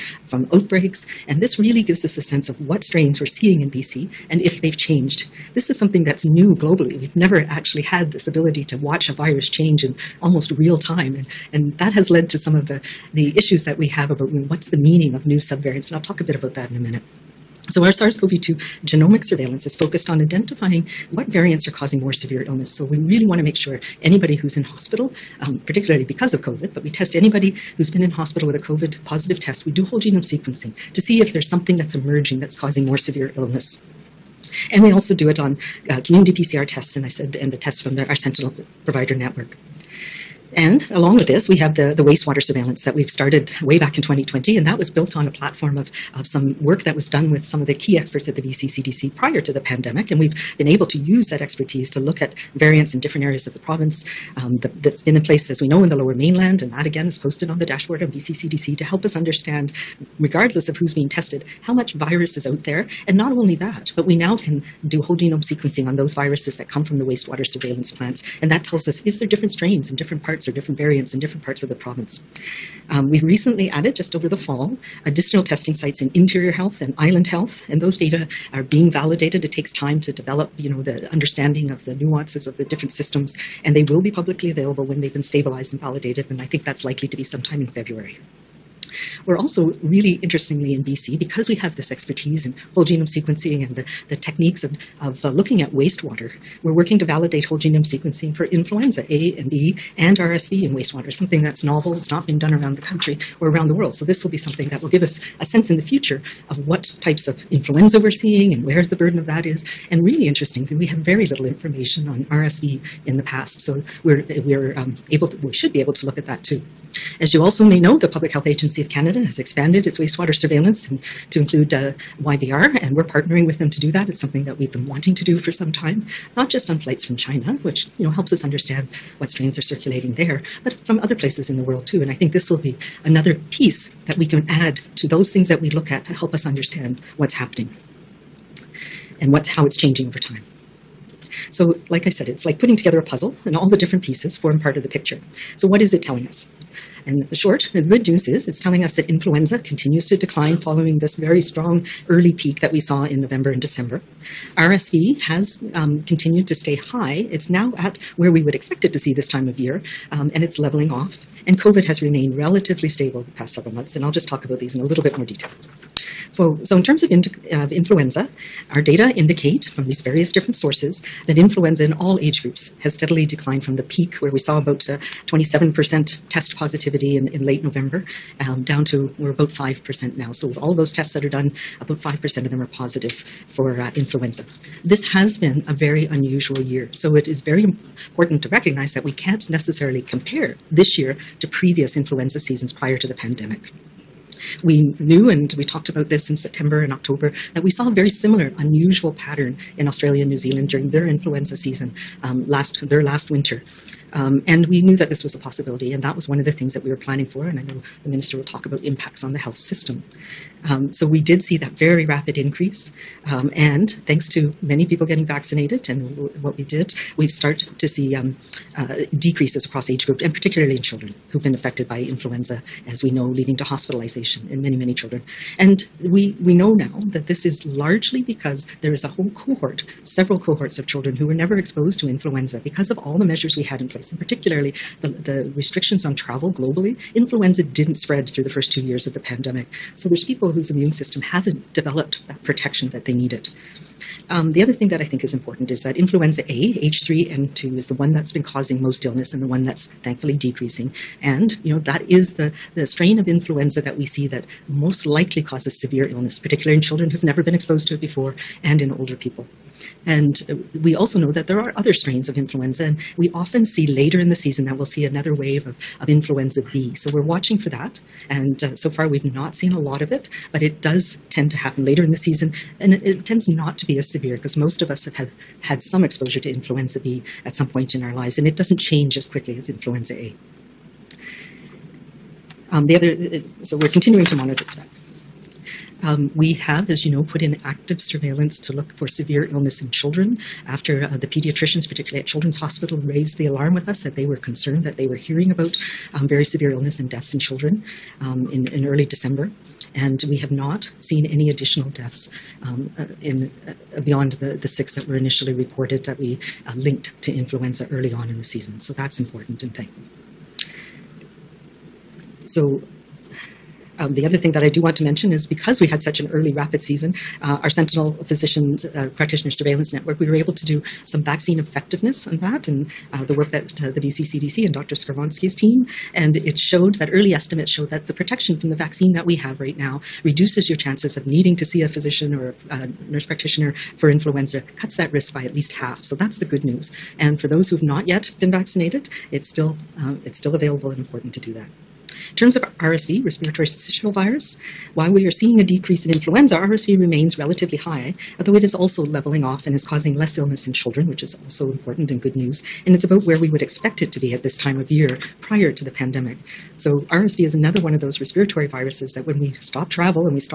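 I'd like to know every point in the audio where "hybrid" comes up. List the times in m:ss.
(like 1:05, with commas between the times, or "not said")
not said.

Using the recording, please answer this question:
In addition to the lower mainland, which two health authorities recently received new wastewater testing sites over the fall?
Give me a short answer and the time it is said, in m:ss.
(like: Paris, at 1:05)
Interior Health and Island Health, at 1:16.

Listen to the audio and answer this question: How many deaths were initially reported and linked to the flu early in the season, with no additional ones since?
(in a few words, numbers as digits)
6.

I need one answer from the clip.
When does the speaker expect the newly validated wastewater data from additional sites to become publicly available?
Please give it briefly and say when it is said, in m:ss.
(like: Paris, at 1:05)
February, at 1:27.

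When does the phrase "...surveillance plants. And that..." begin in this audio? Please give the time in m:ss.
1:07.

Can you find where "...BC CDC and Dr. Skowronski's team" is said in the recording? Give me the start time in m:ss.
5:23.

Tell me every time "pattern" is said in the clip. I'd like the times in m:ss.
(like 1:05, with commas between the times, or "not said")
3:19.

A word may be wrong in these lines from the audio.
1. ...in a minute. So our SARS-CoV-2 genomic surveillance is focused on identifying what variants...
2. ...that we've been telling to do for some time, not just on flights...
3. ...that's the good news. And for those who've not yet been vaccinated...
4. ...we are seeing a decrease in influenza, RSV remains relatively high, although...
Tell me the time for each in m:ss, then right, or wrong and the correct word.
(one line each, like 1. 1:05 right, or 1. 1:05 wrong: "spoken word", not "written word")
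1. 0:16 right
2. 2:04 wrong: "wanting", not "telling"
3. 5:36 right
4. 5:45 right.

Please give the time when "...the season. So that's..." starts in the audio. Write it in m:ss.
5:08.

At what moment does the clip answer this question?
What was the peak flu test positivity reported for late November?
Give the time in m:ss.
2:54.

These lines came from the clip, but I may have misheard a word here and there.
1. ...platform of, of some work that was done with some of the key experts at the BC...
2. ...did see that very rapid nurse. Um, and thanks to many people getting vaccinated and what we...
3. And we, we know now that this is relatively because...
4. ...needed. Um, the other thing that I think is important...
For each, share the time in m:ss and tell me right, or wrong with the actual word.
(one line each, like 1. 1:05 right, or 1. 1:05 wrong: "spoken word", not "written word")
1. 0:45 right
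2. 3:31 wrong: "increase", not "nurse"
3. 3:45 wrong: "largely", not "relatively"
4. 4:03 right.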